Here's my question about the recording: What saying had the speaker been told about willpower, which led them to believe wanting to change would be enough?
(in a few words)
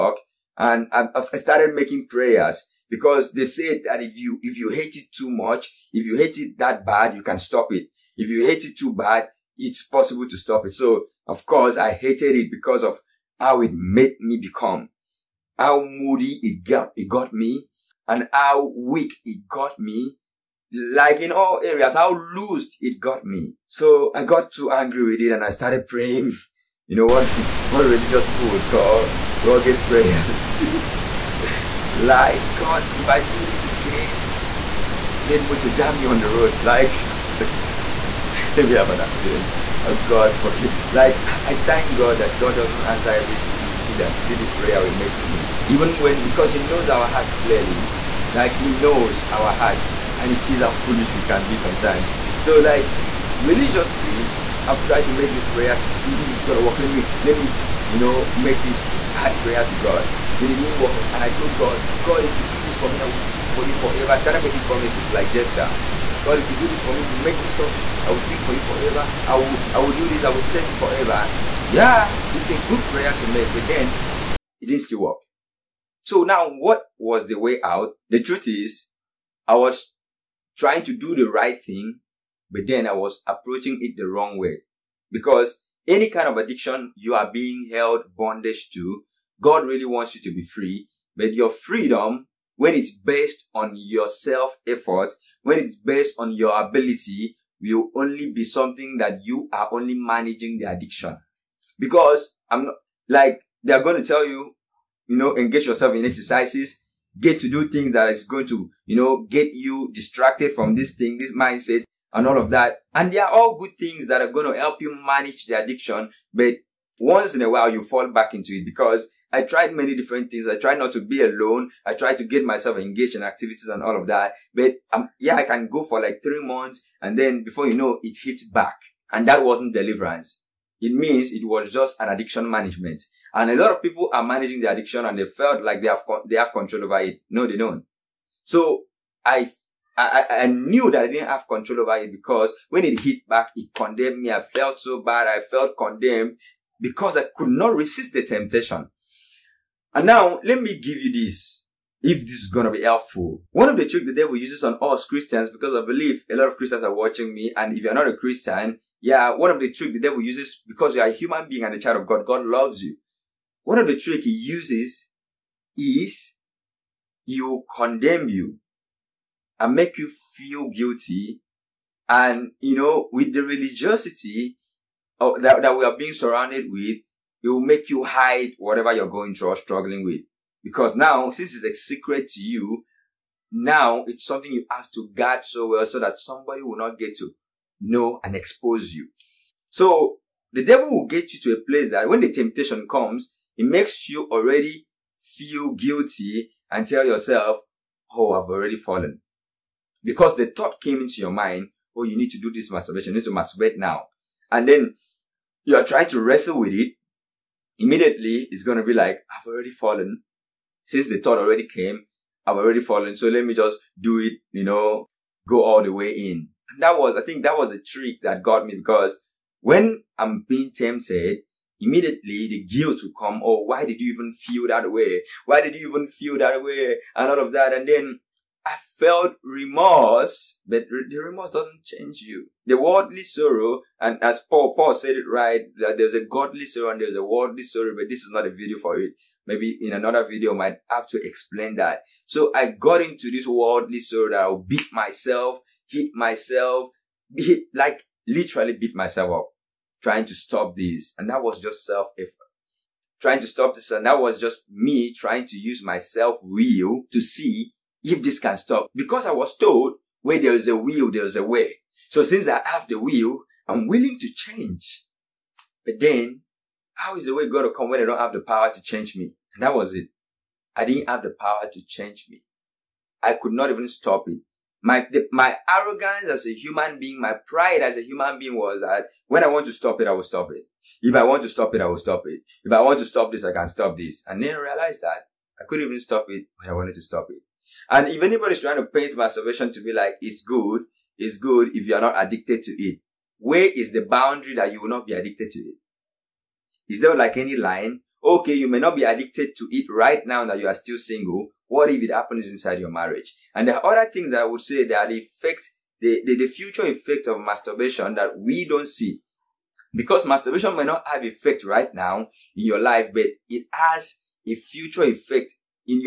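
Where there is a will, there is a way.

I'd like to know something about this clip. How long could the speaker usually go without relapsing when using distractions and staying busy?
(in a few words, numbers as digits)
3 months.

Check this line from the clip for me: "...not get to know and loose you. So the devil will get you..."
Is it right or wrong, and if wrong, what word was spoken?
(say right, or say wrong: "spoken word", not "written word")
wrong: "expose", not "loose".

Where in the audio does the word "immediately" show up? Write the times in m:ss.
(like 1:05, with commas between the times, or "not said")
3:27, 3:41.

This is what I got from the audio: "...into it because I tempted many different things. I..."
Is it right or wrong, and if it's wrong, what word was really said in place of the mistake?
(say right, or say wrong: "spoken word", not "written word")
wrong: "tried", not "tempted".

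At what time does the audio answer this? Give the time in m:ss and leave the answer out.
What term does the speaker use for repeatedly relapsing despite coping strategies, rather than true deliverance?
2:12.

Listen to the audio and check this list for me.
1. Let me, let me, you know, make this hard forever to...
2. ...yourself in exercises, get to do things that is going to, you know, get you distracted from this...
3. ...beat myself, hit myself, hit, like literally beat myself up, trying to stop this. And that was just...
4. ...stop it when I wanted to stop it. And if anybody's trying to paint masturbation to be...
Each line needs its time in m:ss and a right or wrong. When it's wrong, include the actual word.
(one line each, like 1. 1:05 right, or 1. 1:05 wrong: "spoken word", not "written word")
1. 0:56 wrong: "prayer", not "forever"
2. 1:45 right
3. 4:04 right
4. 4:45 right.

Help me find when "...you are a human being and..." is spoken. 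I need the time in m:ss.
2:40.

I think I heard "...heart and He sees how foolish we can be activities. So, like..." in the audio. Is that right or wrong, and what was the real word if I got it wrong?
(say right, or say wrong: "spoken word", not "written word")
wrong: "sometimes", not "activities".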